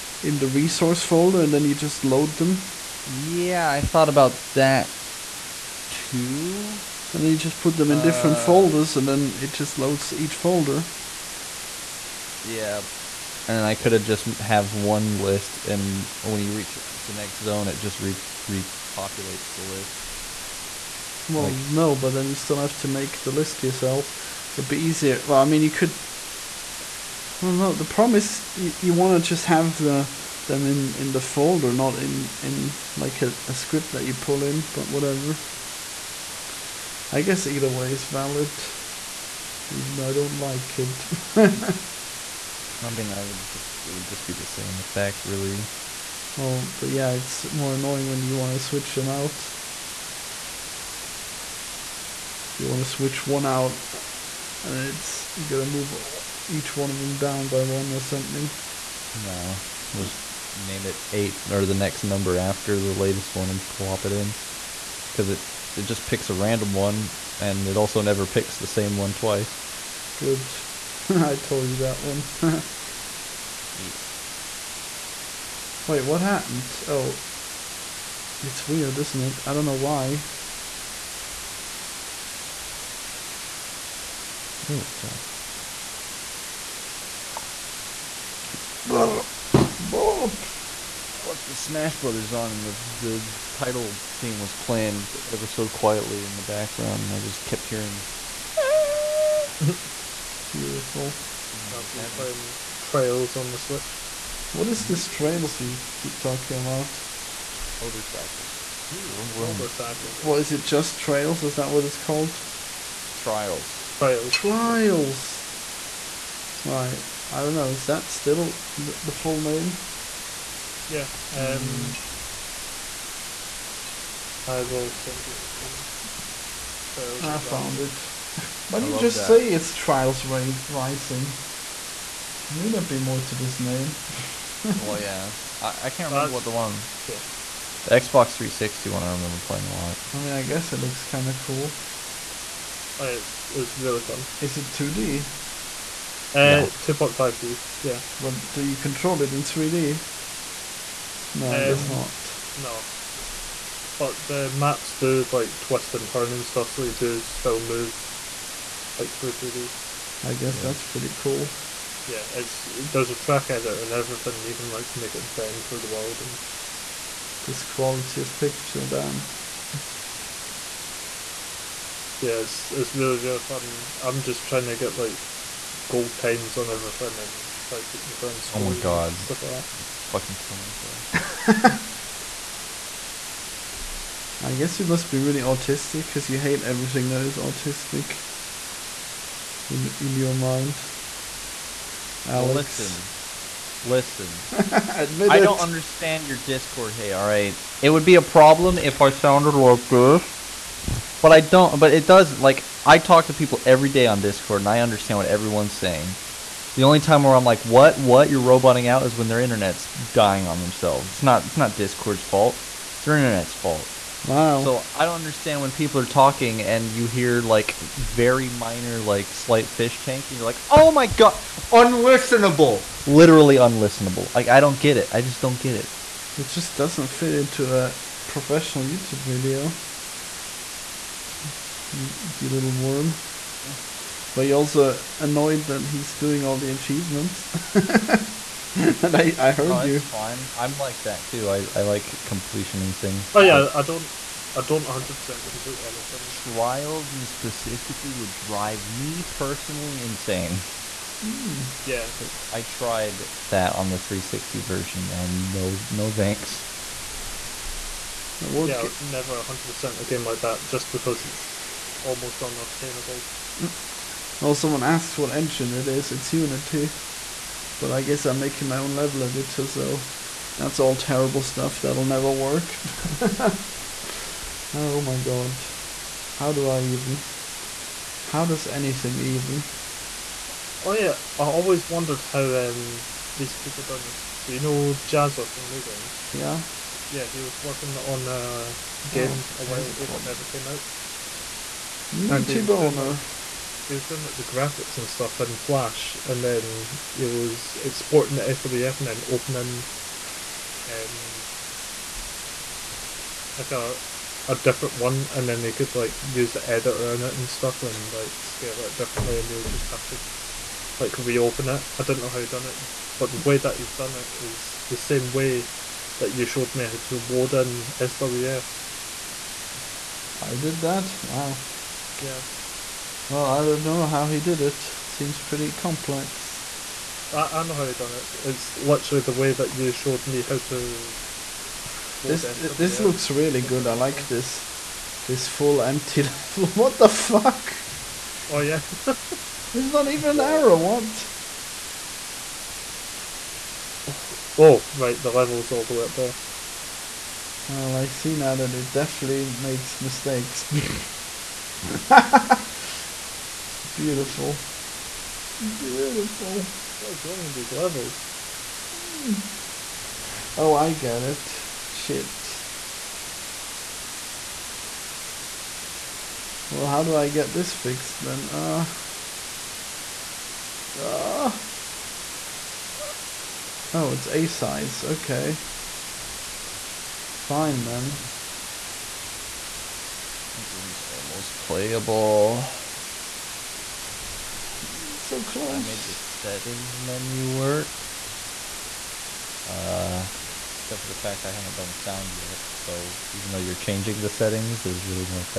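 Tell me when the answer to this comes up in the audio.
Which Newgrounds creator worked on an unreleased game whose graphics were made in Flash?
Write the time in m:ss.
4:45.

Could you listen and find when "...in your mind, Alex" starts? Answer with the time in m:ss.
3:09.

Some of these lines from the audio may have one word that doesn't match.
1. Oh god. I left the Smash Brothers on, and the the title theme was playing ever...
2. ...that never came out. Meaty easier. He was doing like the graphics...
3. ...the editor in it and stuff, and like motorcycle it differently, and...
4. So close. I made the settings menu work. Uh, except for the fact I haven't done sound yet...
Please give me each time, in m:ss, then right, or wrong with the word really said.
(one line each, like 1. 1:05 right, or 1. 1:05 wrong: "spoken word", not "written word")
1. 1:24 right
2. 4:50 wrong: "boner", not "easier"
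3. 5:06 wrong: "scale", not "motorcycle"
4. 6:25 right.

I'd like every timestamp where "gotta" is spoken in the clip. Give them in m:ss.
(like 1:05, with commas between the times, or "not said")
0:55.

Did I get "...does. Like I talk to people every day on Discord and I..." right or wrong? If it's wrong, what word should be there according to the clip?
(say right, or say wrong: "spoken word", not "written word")
right.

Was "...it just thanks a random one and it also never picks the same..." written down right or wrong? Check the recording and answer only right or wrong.
wrong.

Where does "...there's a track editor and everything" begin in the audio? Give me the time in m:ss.
2:42.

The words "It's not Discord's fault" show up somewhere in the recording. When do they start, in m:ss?
3:31.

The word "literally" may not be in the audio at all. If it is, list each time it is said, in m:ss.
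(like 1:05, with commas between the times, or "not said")
3:43, 5:28.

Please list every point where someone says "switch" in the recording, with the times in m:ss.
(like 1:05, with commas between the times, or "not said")
0:48, 0:52, 1:43.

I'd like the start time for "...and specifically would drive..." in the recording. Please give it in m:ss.
4:07.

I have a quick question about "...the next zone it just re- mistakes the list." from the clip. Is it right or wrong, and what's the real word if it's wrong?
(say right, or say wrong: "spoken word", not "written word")
wrong: "repopulates", not "mistakes".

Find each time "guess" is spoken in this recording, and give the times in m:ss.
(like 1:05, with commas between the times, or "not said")
0:37, 2:20, 2:40, 3:04, 4:28.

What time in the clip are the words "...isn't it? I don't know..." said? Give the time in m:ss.
1:18.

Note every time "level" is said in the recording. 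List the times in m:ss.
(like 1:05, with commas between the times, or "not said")
4:28, 5:36, 5:45, 5:57.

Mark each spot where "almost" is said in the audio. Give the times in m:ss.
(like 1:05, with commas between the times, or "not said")
4:22, 6:21.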